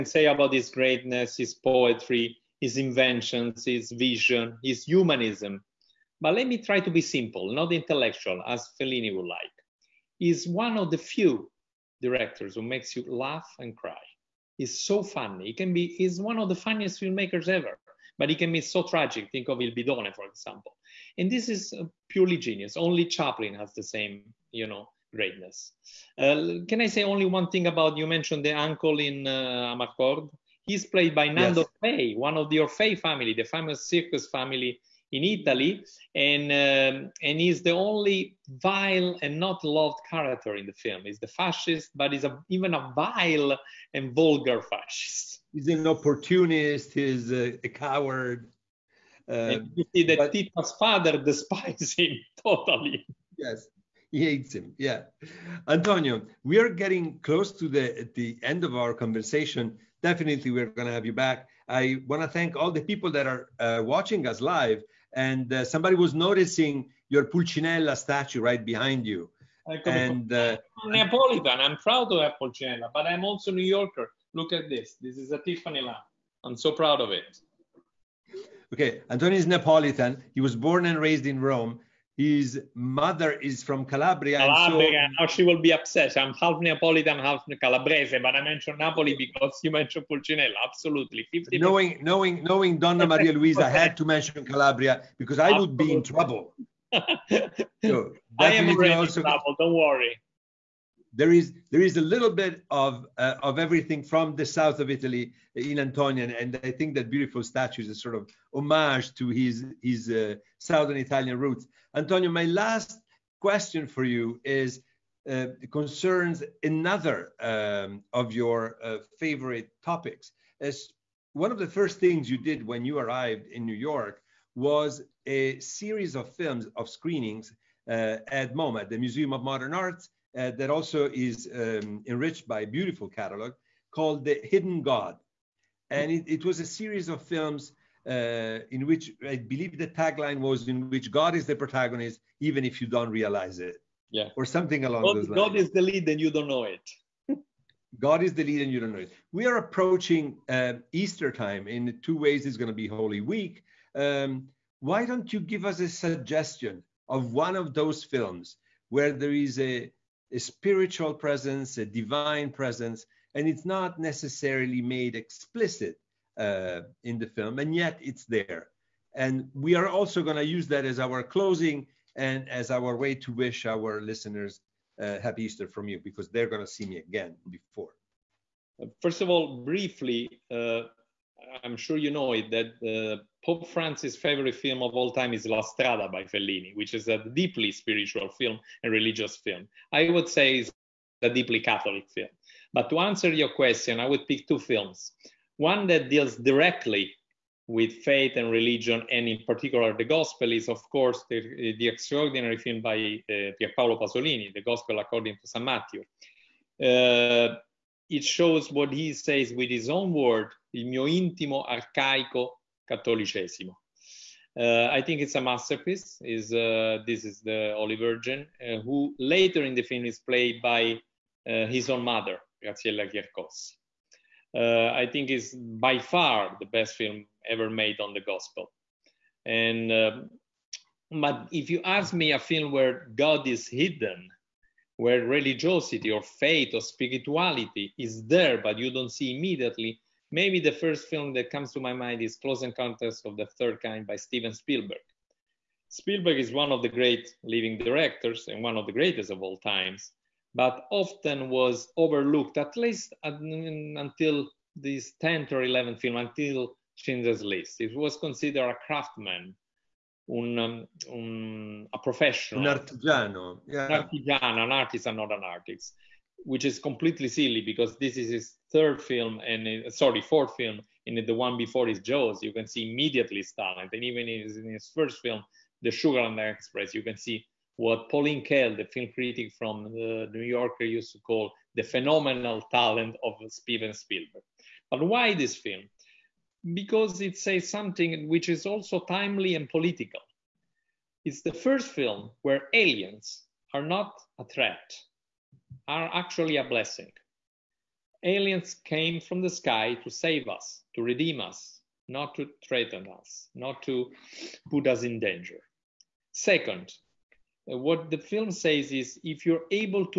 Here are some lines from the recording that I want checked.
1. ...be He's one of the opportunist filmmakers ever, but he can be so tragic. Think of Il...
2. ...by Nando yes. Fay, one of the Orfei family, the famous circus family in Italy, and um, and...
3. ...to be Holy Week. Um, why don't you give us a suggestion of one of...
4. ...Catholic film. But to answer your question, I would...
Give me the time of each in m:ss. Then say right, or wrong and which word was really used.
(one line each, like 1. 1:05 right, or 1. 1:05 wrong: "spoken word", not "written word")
1. 0:15 wrong: "funniest", not "opportunist"
2. 0:31 right
3. 2:32 right
4. 3:11 right.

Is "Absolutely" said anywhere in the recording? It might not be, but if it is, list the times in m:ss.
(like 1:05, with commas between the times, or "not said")
1:30, 1:35.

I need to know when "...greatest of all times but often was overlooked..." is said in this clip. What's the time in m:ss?
4:08.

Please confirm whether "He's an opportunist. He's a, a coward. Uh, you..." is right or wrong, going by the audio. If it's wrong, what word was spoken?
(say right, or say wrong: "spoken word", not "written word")
right.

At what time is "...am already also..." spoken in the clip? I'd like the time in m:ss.
1:38.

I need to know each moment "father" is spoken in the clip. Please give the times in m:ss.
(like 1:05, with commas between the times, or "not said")
0:50.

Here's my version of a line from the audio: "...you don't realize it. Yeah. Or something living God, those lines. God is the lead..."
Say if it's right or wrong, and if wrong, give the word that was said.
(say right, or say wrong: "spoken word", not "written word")
wrong: "along", not "living".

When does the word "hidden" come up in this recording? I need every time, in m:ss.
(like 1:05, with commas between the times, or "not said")
2:14, 3:53.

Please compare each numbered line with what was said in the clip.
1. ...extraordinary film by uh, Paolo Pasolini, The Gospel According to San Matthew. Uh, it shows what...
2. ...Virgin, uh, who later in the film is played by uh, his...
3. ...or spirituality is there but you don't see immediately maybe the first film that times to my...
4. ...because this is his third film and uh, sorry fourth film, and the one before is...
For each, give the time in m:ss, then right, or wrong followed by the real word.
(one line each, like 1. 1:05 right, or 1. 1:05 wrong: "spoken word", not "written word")
1. 3:21 right
2. 3:37 right
3. 3:56 wrong: "comes", not "times"
4. 4:27 right.